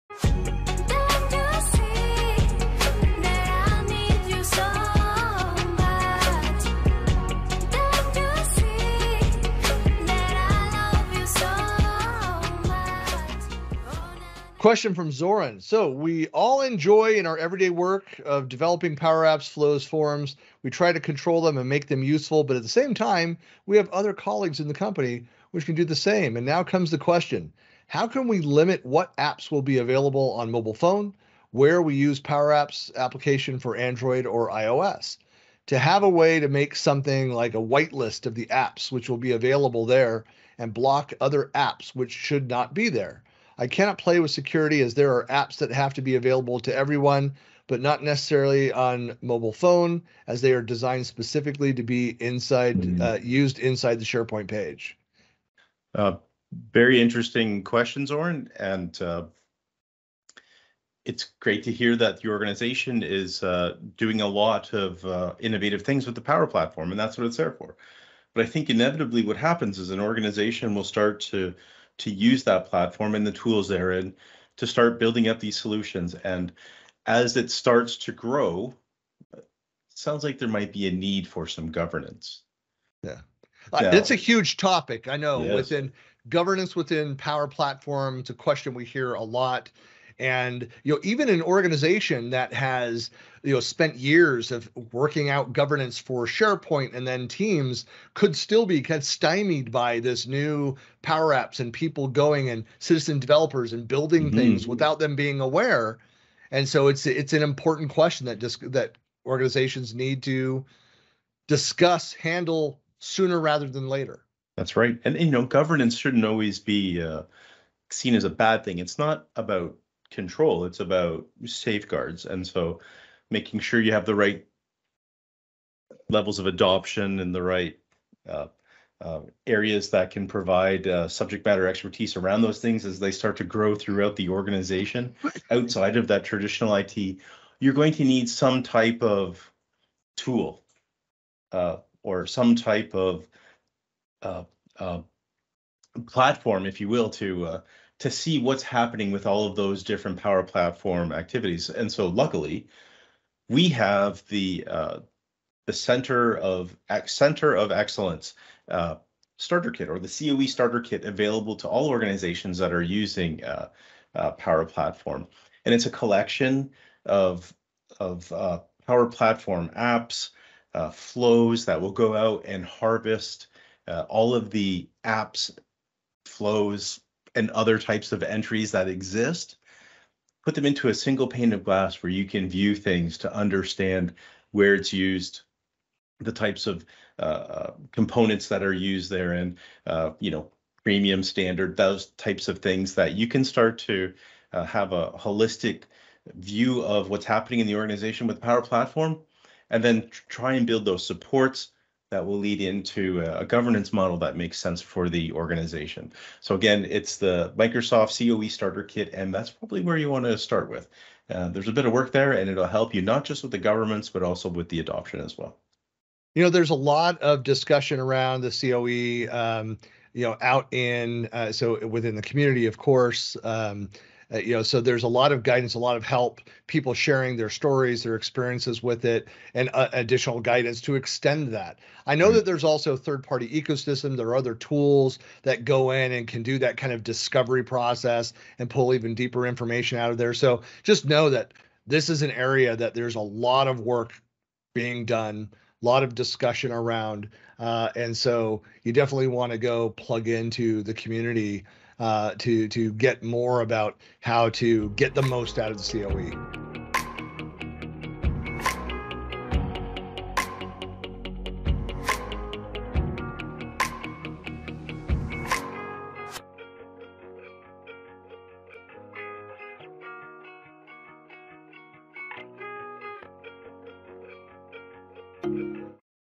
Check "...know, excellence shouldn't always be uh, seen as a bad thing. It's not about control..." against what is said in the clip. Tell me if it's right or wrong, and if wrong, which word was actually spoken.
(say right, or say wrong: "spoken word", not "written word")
wrong: "governance", not "excellence".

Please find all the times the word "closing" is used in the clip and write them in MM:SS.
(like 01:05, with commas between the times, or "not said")
not said.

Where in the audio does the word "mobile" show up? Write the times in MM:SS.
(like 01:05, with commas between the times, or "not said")
00:30, 00:49.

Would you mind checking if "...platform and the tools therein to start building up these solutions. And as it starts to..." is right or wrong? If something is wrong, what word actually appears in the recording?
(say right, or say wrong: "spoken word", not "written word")
right.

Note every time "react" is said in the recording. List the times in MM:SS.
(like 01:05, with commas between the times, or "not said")
not said.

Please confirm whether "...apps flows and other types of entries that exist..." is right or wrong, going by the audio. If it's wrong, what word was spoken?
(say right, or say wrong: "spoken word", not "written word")
right.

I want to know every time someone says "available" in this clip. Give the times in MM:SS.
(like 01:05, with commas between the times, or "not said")
00:29, 00:39, 00:46, 02:41.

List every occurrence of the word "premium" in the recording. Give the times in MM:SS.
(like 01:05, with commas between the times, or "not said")
03:10.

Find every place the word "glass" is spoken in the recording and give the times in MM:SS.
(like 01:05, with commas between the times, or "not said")
03:01.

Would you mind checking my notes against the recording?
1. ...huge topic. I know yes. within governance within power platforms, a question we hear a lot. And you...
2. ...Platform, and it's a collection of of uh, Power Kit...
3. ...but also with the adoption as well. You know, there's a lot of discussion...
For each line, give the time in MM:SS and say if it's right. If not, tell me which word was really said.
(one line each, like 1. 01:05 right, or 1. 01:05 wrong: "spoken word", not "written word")
1. 01:24 right
2. 02:44 wrong: "Platform", not "Kit"
3. 03:34 right.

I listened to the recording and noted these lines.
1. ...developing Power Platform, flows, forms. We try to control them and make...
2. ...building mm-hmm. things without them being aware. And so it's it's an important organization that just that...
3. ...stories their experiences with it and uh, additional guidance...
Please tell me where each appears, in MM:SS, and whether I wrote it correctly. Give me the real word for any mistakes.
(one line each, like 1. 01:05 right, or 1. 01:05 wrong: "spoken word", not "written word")
1. 00:18 wrong: "Apps", not "Platform"
2. 01:43 wrong: "question", not "organization"
3. 03:47 right.